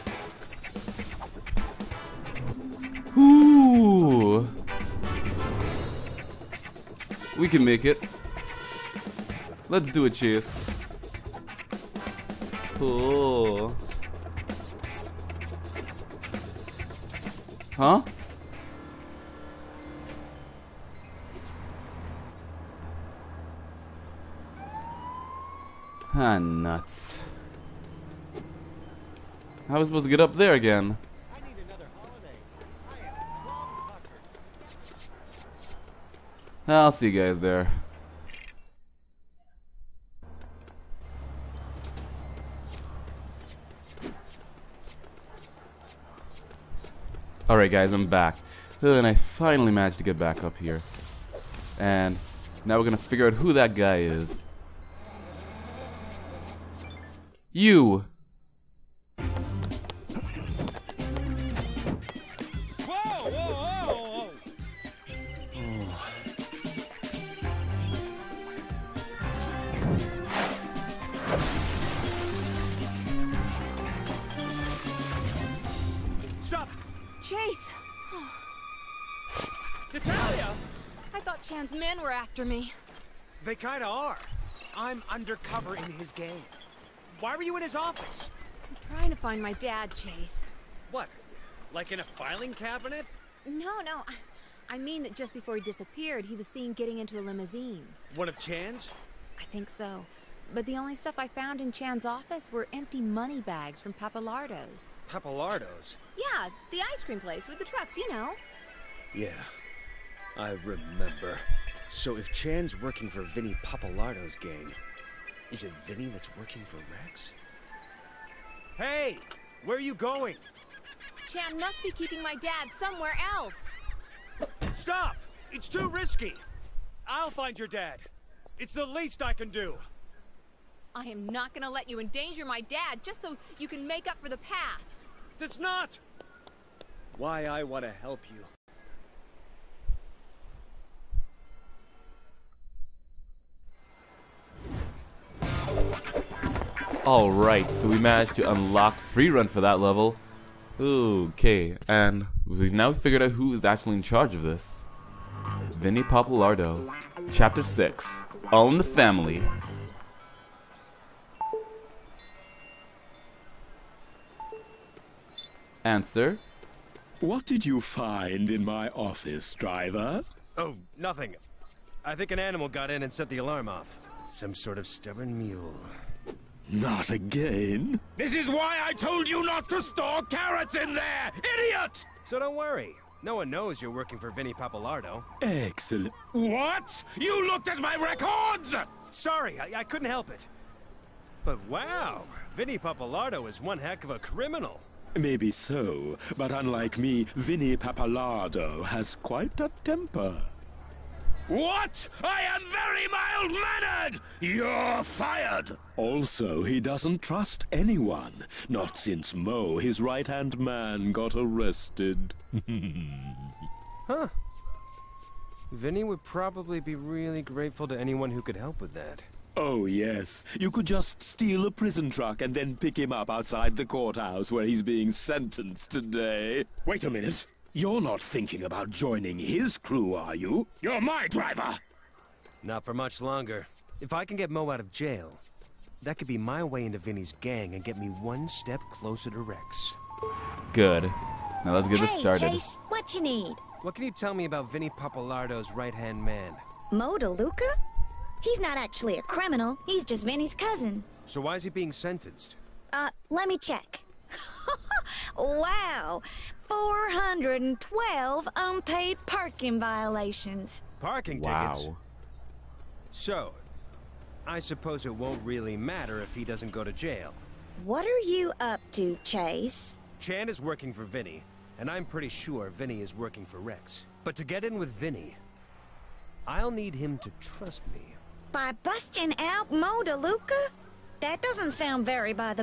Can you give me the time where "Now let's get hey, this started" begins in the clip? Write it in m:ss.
4:01.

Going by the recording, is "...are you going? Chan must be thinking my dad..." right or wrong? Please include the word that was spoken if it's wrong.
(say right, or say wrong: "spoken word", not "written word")
wrong: "keeping", not "thinking".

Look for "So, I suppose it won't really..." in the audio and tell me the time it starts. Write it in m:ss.
4:23.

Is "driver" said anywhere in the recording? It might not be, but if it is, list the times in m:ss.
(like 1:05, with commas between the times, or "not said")
2:49, 3:51.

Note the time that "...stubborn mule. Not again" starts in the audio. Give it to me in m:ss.
2:54.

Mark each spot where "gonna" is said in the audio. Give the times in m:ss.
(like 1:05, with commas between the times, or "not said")
0:52, 2:11.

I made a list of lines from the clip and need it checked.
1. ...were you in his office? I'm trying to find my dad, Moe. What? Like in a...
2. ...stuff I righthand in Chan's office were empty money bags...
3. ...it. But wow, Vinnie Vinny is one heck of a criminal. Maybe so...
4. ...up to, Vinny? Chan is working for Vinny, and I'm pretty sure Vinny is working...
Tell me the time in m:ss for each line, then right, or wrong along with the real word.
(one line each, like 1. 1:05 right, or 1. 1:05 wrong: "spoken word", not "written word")
1. 1:27 wrong: "Chase", not "Moe"
2. 1:40 wrong: "found", not "righthand"
3. 3:10 wrong: "Pappalardo", not "Vinny"
4. 4:28 wrong: "Chase", not "Vinny".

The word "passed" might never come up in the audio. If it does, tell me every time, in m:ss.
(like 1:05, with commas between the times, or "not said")
not said.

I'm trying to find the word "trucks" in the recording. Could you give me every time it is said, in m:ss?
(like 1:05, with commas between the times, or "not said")
1:47, 3:42.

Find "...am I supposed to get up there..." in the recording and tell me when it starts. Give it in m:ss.
0:29.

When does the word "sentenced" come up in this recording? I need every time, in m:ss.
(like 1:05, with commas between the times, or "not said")
3:45, 4:11.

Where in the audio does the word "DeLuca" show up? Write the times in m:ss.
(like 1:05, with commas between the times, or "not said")
4:07, 4:40.